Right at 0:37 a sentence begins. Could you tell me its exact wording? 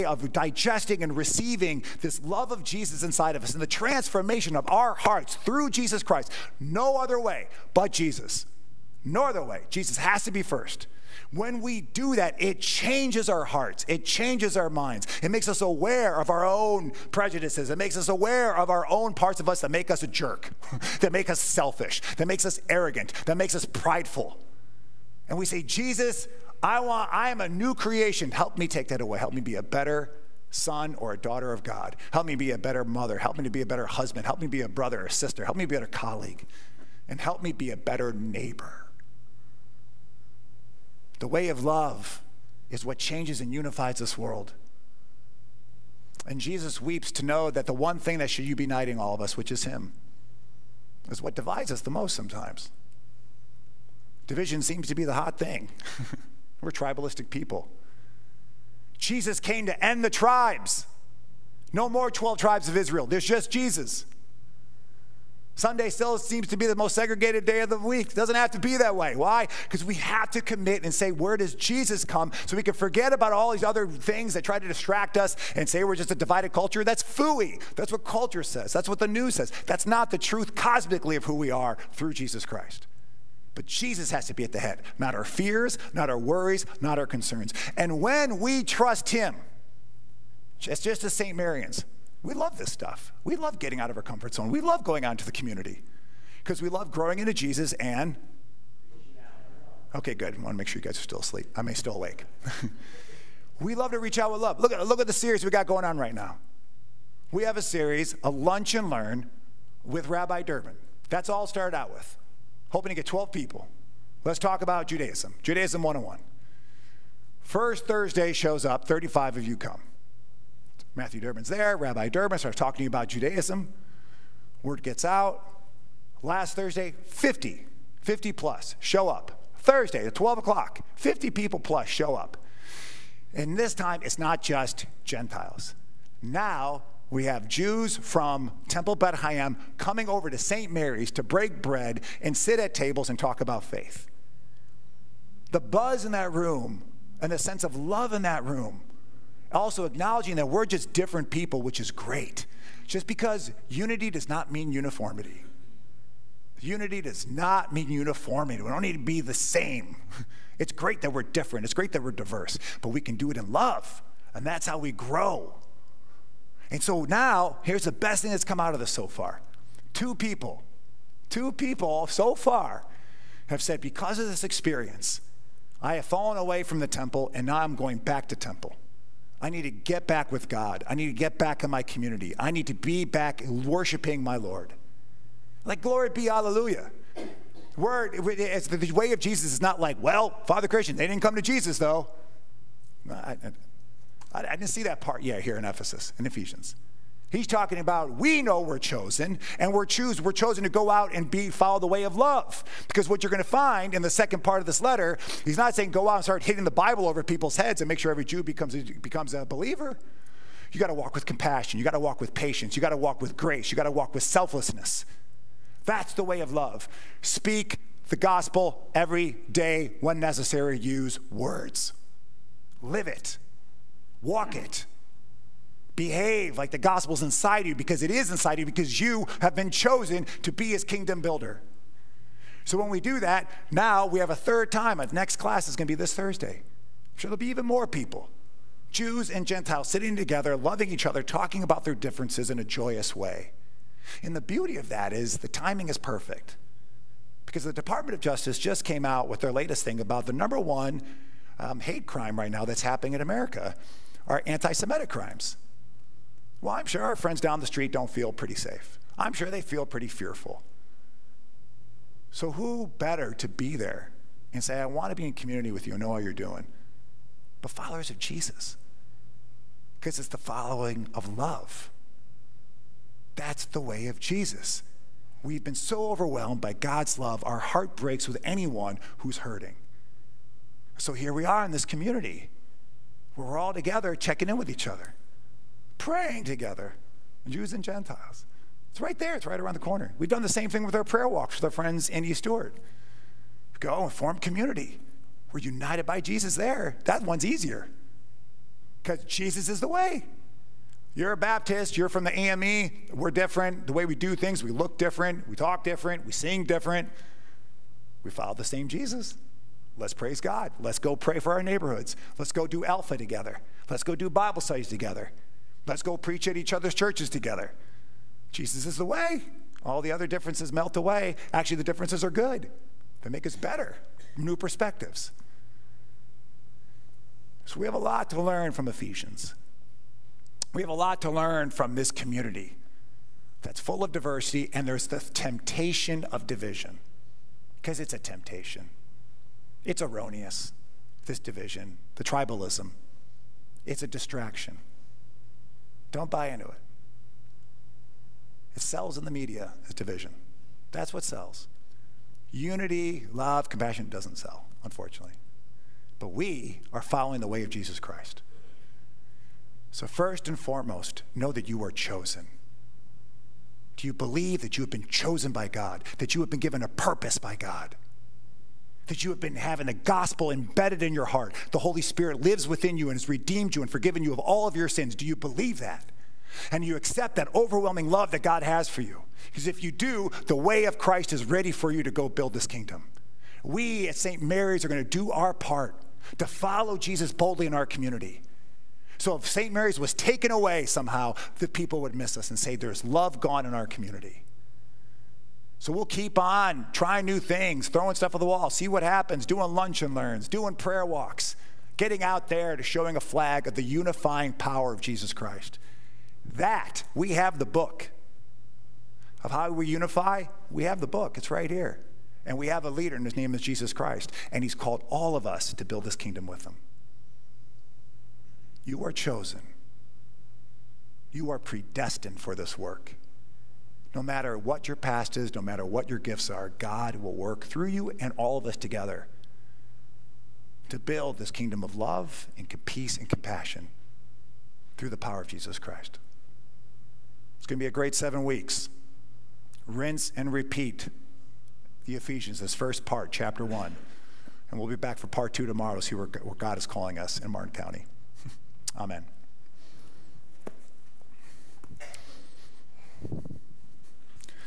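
And help me be a better neighbor.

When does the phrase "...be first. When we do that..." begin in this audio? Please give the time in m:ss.
0:10.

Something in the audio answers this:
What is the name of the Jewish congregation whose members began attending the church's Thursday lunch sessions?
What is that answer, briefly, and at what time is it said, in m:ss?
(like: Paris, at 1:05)
Temple Beit HaYam, at 2:18.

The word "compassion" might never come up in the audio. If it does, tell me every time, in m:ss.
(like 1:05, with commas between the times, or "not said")
3:31, 5:53, 7:13.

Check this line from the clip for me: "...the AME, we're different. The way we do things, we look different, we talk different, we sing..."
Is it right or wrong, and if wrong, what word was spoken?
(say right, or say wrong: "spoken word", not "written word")
right.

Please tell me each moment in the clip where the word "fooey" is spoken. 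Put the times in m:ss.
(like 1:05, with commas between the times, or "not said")
1:17.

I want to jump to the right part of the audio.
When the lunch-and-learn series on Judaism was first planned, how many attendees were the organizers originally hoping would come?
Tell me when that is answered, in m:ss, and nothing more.
1:53.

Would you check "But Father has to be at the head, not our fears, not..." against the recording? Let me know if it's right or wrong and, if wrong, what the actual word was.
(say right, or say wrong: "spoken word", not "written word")
wrong: "Jesus", not "Father".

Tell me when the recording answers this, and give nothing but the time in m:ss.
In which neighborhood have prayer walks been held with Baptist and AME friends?
4:52.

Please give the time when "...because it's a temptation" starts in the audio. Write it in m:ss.
5:37.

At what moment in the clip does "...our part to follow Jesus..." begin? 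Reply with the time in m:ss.
6:25.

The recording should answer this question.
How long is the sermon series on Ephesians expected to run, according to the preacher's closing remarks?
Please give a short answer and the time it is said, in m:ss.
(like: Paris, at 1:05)
7 weeks, at 7:18.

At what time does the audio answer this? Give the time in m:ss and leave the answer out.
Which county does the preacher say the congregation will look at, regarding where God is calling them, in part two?
7:27.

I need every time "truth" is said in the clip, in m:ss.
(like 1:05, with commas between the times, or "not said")
1:20.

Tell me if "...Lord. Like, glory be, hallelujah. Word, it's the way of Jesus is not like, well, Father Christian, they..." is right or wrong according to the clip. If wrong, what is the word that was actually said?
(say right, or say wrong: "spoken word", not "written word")
right.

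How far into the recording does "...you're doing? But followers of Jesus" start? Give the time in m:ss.
4:26.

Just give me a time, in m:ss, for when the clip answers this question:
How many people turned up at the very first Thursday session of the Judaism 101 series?
1:58.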